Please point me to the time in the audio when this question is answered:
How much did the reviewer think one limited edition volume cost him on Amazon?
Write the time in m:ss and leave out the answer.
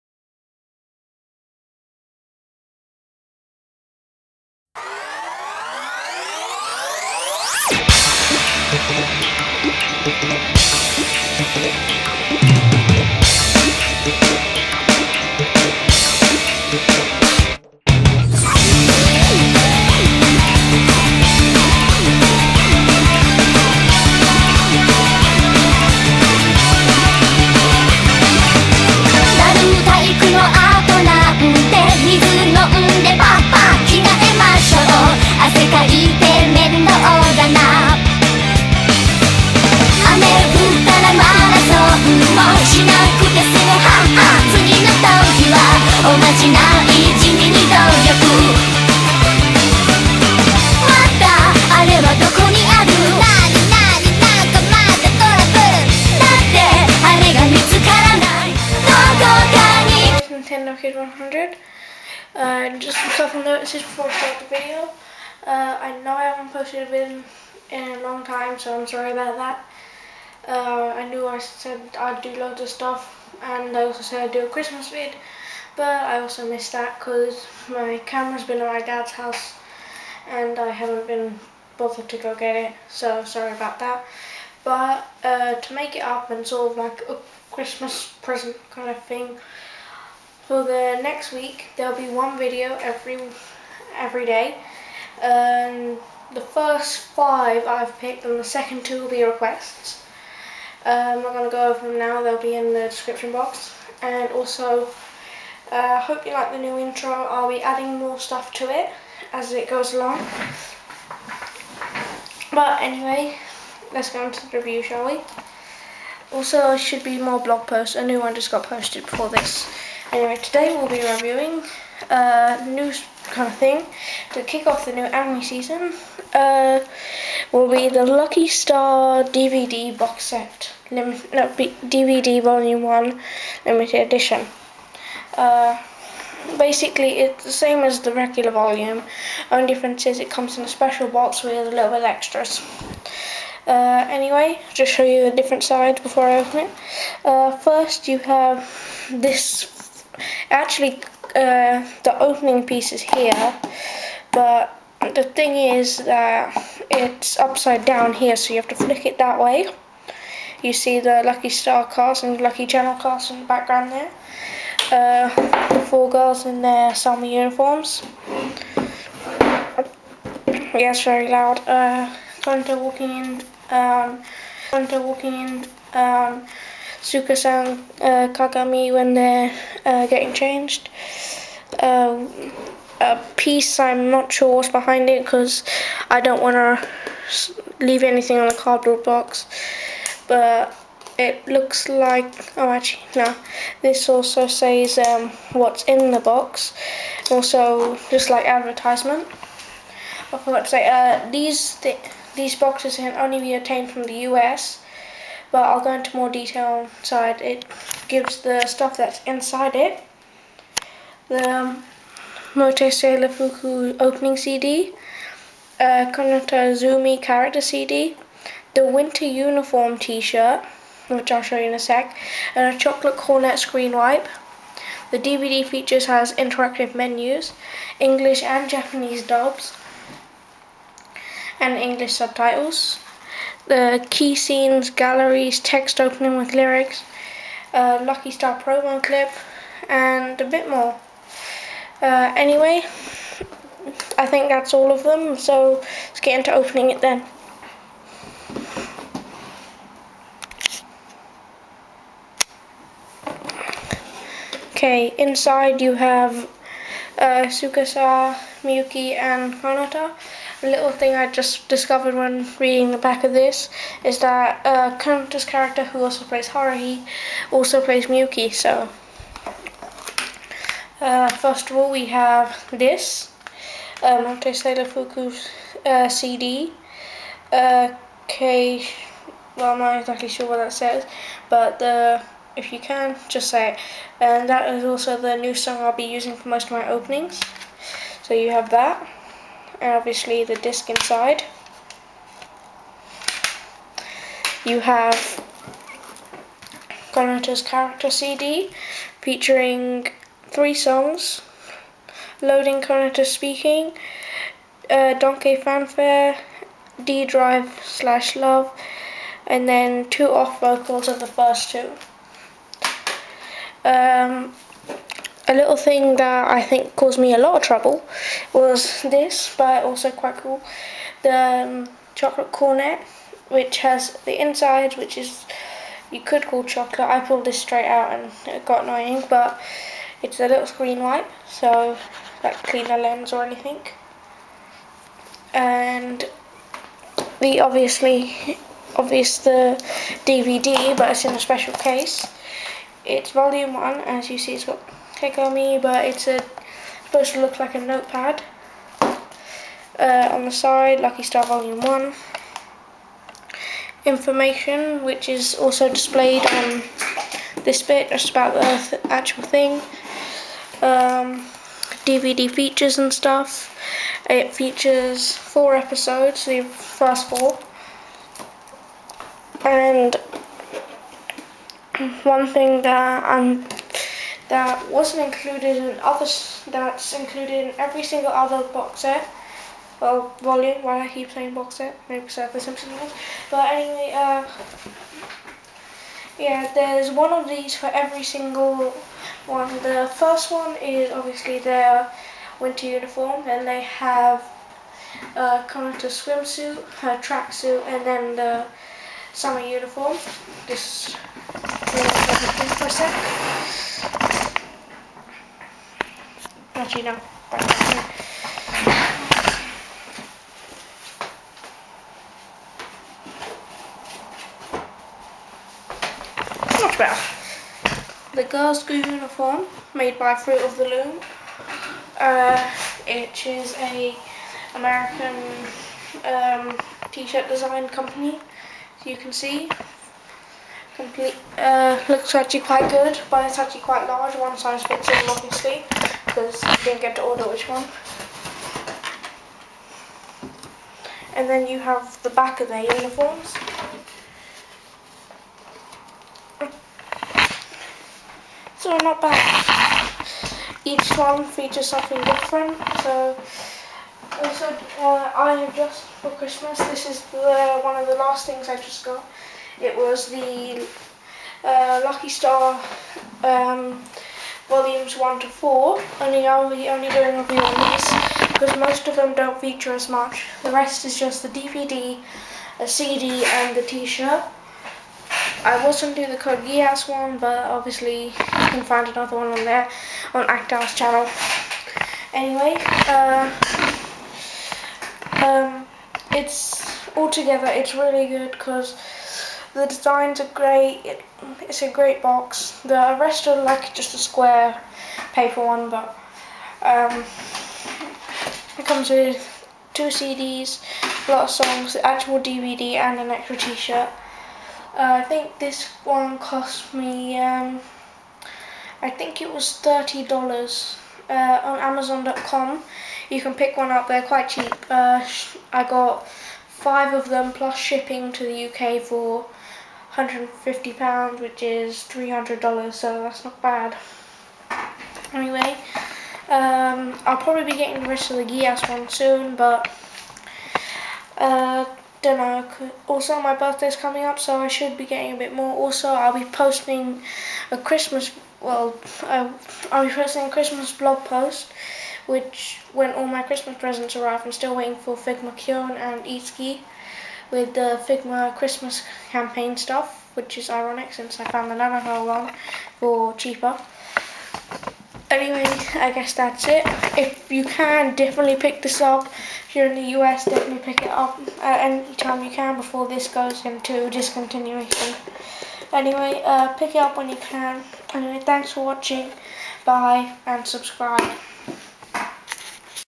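8:29.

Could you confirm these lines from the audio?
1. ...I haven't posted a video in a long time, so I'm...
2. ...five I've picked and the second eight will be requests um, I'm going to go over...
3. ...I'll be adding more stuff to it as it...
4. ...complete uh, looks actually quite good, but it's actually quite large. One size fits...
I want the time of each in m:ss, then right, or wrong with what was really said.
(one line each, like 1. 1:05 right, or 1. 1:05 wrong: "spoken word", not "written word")
1. 1:06 right
2. 1:37 wrong: "two", not "eight"
3. 1:47 right
4. 7:10 right.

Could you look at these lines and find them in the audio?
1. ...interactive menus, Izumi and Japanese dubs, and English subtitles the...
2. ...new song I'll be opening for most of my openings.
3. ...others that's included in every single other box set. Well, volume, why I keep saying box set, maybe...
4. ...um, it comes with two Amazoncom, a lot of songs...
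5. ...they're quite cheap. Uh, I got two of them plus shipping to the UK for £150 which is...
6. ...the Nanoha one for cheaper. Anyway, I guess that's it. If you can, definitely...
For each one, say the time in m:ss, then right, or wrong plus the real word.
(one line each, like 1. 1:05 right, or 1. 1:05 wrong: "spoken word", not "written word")
1. 3:46 wrong: "English", not "Izumi"
2. 4:45 wrong: "using", not "opening"
3. 6:16 right
4. 8:16 wrong: "CDs", not "Amazoncom"
5. 8:34 wrong: "five", not "two"
6. 9:11 right.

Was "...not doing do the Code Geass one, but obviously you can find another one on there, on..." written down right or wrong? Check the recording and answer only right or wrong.
right.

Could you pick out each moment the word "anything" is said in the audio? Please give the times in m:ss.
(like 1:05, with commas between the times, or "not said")
3:08, 5:33.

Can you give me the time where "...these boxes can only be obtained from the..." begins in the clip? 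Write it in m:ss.
3:22.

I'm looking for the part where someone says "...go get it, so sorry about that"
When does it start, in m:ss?
1:22.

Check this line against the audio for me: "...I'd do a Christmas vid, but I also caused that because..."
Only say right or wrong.
wrong.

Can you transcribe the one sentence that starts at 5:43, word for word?
It's volume one, as you see, it's got on Me, but it's a, supposed to look like a notepad.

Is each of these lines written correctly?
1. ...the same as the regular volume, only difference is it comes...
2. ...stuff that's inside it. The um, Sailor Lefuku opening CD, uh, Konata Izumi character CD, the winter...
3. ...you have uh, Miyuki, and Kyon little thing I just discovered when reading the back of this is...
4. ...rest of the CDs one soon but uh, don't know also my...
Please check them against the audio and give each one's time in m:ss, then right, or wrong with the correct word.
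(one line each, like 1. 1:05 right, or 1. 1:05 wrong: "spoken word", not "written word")
1. 2:17 right
2. 3:28 right
3. 4:15 wrong: "Konata", not "Kyon"
4. 8:48 wrong: "Geass", not "CDs".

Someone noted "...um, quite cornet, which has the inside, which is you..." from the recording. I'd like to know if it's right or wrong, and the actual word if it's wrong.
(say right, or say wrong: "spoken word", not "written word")
wrong: "chocolate", not "quite".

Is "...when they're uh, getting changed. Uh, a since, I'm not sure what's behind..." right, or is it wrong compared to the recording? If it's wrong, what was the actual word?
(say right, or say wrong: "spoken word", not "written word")
wrong: "piece", not "since".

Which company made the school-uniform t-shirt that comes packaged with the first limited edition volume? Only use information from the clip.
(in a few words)
Fruit of the Loom.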